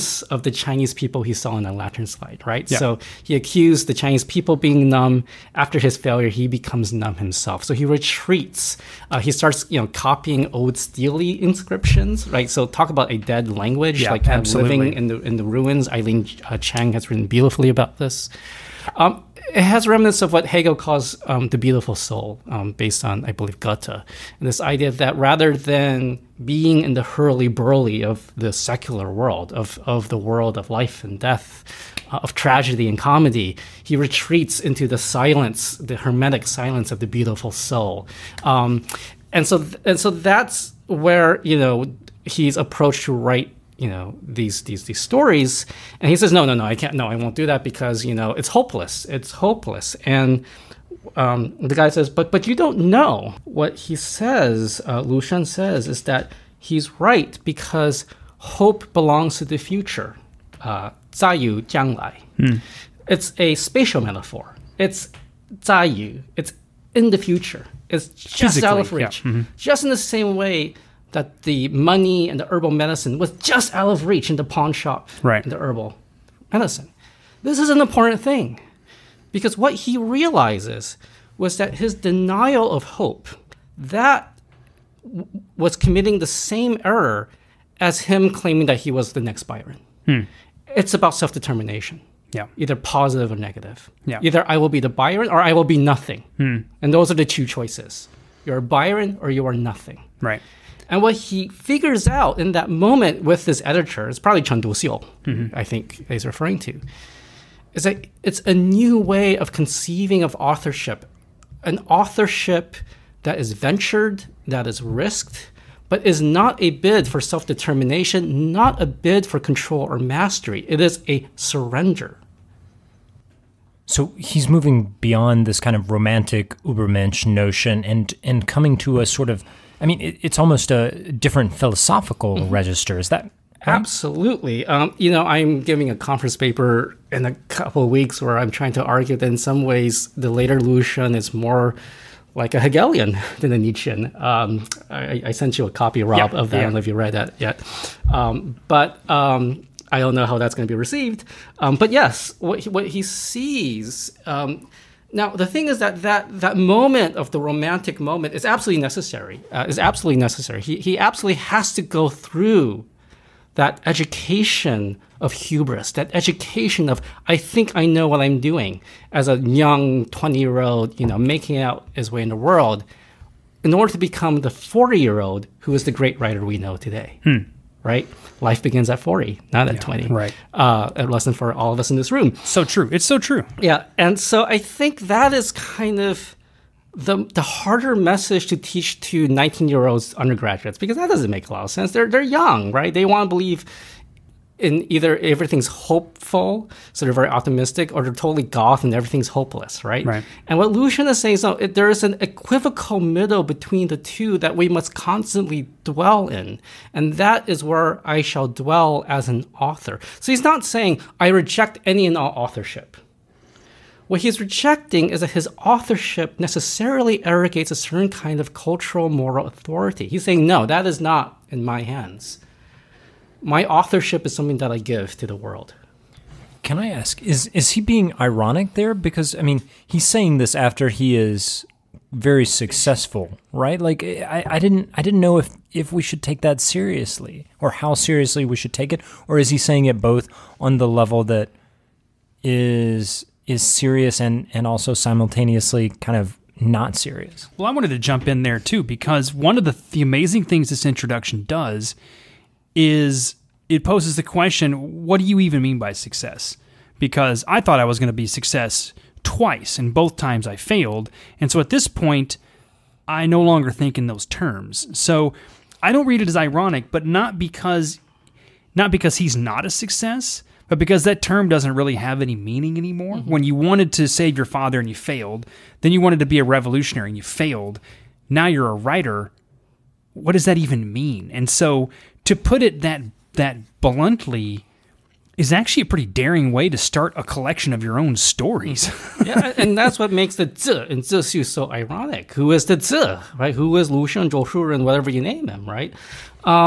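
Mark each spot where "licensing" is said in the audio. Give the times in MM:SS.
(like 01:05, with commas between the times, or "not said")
not said.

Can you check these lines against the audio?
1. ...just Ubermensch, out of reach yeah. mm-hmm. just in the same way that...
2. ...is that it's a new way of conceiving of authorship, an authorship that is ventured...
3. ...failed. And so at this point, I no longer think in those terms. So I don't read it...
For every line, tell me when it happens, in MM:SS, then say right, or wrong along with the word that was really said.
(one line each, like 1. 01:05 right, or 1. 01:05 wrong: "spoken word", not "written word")
1. 01:08 wrong: "Physically", not "Ubermensch"
2. 01:47 right
3. 04:20 right.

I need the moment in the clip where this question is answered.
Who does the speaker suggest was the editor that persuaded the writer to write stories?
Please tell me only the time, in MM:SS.
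01:44.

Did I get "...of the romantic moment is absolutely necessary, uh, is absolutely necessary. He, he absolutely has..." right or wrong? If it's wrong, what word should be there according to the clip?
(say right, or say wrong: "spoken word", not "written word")
right.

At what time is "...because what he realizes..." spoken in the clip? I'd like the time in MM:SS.
01:19.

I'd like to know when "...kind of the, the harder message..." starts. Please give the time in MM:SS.
03:05.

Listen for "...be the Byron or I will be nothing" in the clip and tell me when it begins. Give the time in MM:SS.
01:34.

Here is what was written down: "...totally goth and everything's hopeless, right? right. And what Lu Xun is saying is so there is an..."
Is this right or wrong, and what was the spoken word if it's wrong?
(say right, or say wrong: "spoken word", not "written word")
right.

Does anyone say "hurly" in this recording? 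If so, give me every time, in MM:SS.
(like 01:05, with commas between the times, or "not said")
00:27.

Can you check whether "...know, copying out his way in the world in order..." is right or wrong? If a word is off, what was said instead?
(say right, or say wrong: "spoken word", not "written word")
wrong: "making", not "copying".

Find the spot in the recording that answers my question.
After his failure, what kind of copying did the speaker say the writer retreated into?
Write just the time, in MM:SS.
00:09.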